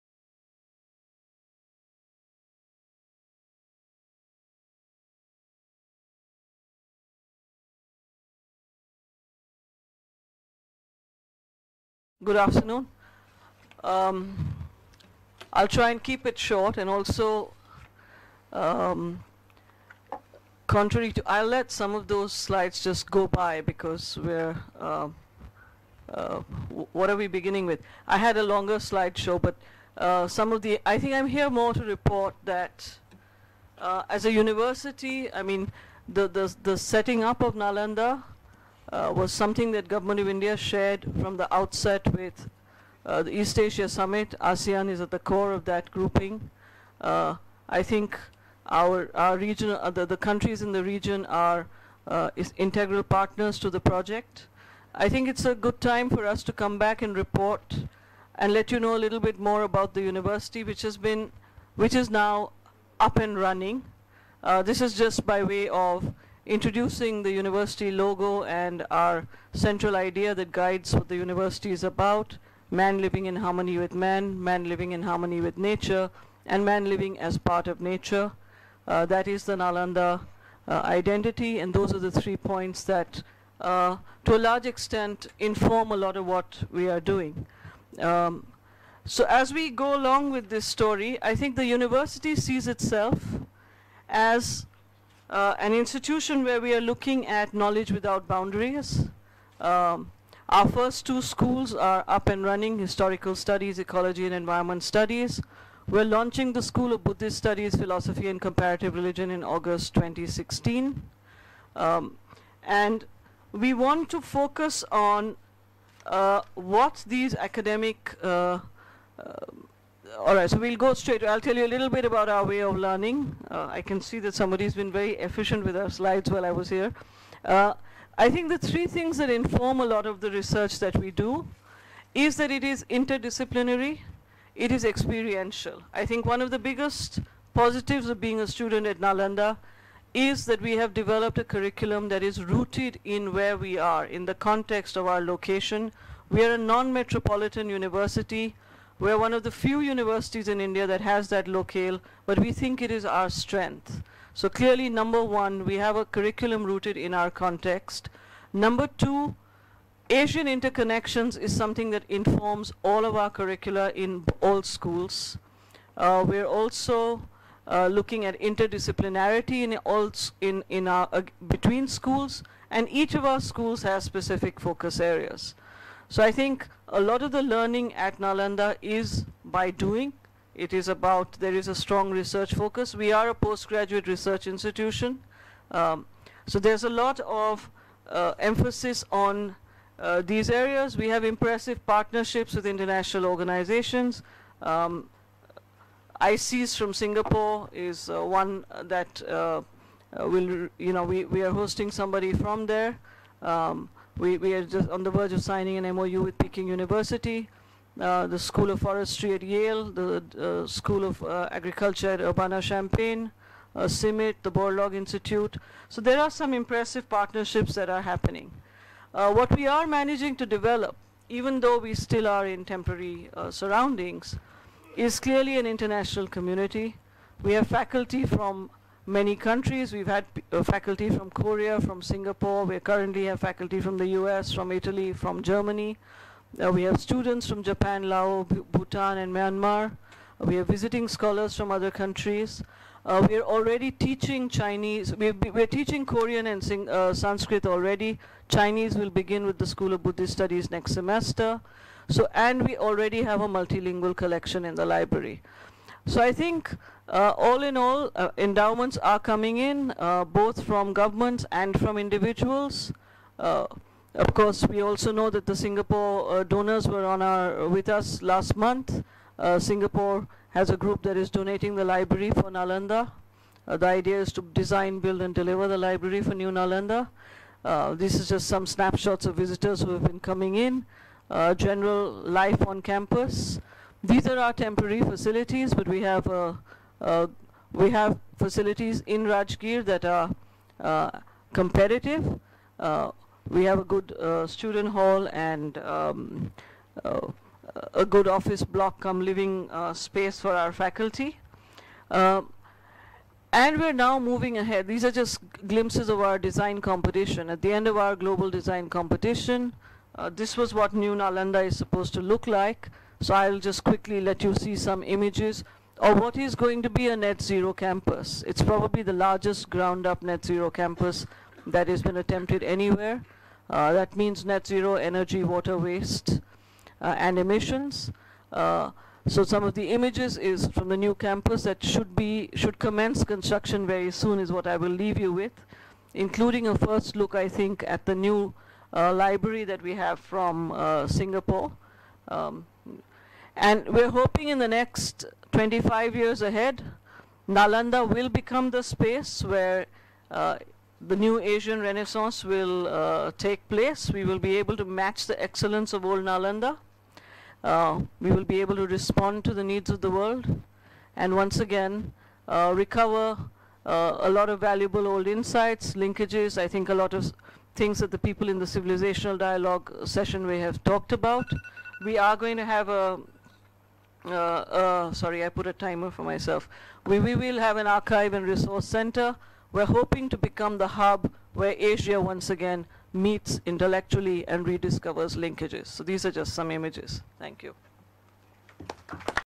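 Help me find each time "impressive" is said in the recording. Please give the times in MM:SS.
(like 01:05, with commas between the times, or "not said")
03:11, 03:36.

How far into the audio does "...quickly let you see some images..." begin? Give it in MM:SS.
05:13.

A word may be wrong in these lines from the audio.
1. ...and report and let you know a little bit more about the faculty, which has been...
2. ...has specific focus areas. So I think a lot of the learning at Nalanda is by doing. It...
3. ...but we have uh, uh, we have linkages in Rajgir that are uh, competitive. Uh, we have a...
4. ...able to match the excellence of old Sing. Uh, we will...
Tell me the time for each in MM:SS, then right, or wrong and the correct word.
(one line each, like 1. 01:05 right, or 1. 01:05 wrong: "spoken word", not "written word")
1. 00:57 wrong: "university", not "faculty"
2. 02:53 right
3. 04:45 wrong: "facilities", not "linkages"
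4. 05:54 wrong: "Nalanda", not "Sing".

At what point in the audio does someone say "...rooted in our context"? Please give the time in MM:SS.
02:36.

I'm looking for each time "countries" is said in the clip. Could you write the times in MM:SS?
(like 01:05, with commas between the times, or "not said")
00:50, 03:49, 04:01.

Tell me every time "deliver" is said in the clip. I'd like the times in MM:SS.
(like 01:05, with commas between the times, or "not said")
04:35.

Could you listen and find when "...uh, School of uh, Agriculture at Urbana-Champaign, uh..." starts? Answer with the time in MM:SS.
03:30.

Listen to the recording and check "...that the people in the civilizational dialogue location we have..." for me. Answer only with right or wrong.
wrong.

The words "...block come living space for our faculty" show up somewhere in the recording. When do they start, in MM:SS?
04:58.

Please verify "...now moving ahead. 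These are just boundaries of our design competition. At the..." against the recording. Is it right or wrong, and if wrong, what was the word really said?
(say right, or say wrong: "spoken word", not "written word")
wrong: "glimpses", not "boundaries".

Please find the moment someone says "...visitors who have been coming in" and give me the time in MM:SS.
04:39.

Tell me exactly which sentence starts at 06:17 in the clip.
We, we will have an archive and resource center.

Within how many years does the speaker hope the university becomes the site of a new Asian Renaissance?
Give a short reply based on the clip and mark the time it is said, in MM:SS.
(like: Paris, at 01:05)
25 years, at 05:45.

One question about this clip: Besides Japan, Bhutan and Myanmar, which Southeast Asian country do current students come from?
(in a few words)
Laos.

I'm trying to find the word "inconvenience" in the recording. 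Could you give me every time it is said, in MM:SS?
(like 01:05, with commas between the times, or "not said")
not said.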